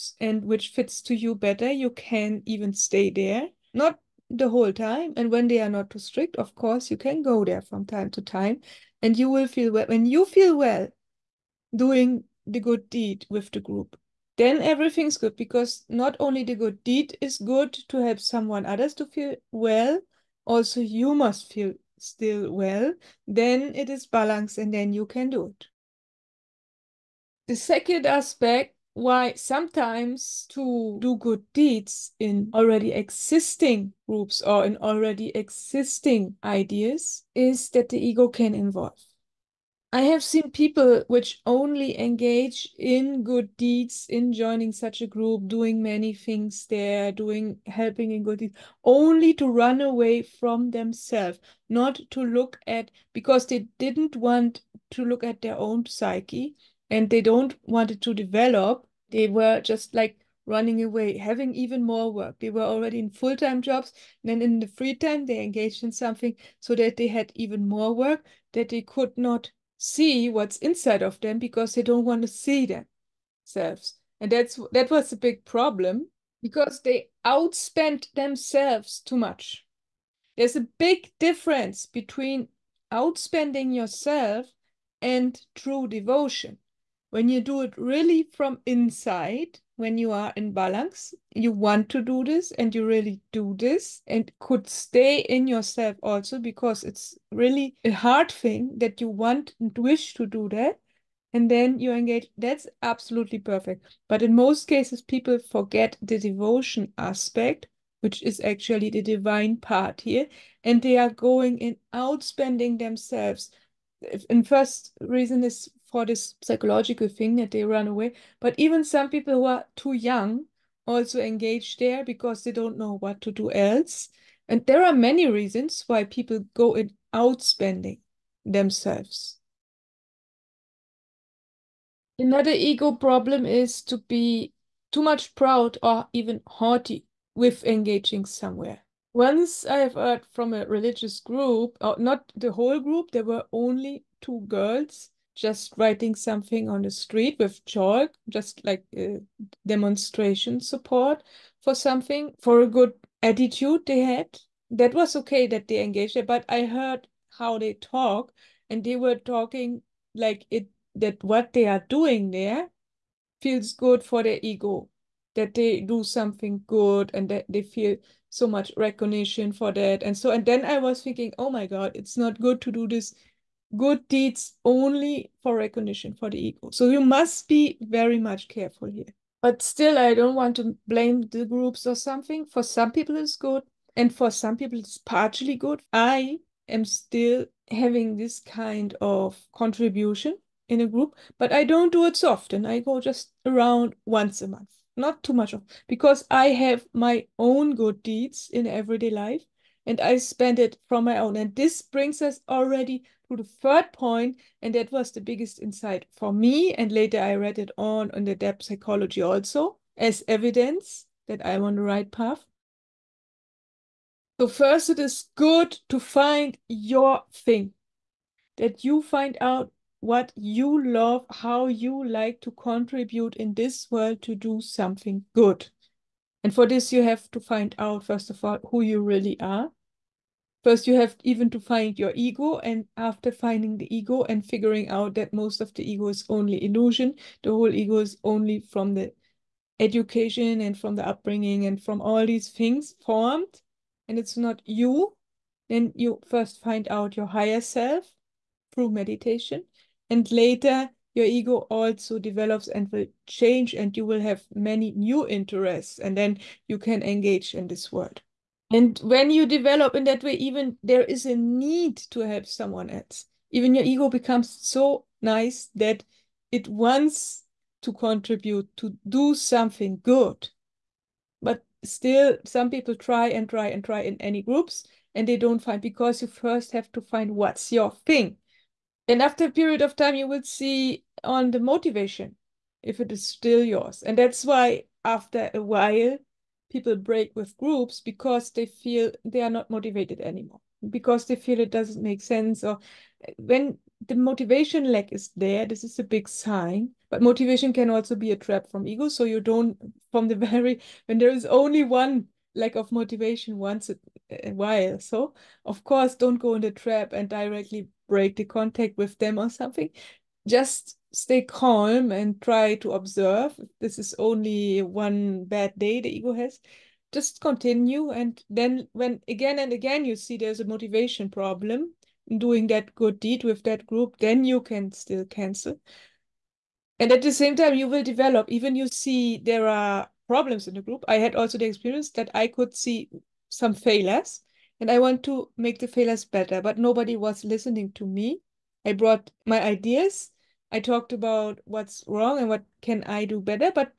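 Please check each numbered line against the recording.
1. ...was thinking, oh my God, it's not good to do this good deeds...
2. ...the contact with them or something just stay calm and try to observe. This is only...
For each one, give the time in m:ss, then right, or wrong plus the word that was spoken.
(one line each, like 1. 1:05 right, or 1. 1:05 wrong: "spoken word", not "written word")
1. 2:50 right
2. 5:08 right.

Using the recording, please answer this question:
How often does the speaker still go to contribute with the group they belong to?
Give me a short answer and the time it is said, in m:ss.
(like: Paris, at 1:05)
once a month, at 3:14.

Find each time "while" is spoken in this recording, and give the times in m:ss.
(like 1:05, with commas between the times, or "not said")
4:45, 5:04.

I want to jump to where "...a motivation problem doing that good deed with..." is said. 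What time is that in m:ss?
5:20.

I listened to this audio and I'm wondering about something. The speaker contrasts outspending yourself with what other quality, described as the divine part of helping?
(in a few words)
true devotion.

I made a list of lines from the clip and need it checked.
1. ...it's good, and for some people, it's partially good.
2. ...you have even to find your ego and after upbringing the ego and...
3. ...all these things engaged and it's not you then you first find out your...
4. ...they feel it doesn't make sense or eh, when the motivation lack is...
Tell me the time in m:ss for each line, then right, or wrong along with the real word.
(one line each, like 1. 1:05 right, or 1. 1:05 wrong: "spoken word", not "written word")
1. 3:03 right
2. 3:50 wrong: "finding", not "upbringing"
3. 4:01 wrong: "formed", not "engaged"
4. 4:51 right.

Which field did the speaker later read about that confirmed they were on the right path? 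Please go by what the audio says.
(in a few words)
depth psychology.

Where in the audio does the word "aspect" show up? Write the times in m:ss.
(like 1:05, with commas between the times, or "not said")
0:28, 1:46.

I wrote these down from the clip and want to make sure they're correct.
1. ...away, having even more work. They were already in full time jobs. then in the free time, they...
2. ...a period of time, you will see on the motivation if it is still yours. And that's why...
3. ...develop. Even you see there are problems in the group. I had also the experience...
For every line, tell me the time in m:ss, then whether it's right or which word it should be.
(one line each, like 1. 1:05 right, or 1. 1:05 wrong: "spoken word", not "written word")
1. 1:00 right
2. 4:39 right
3. 5:28 right.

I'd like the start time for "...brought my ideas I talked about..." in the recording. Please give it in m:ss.
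5:38.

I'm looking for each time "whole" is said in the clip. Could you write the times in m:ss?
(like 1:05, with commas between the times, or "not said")
0:04, 2:22, 3:57.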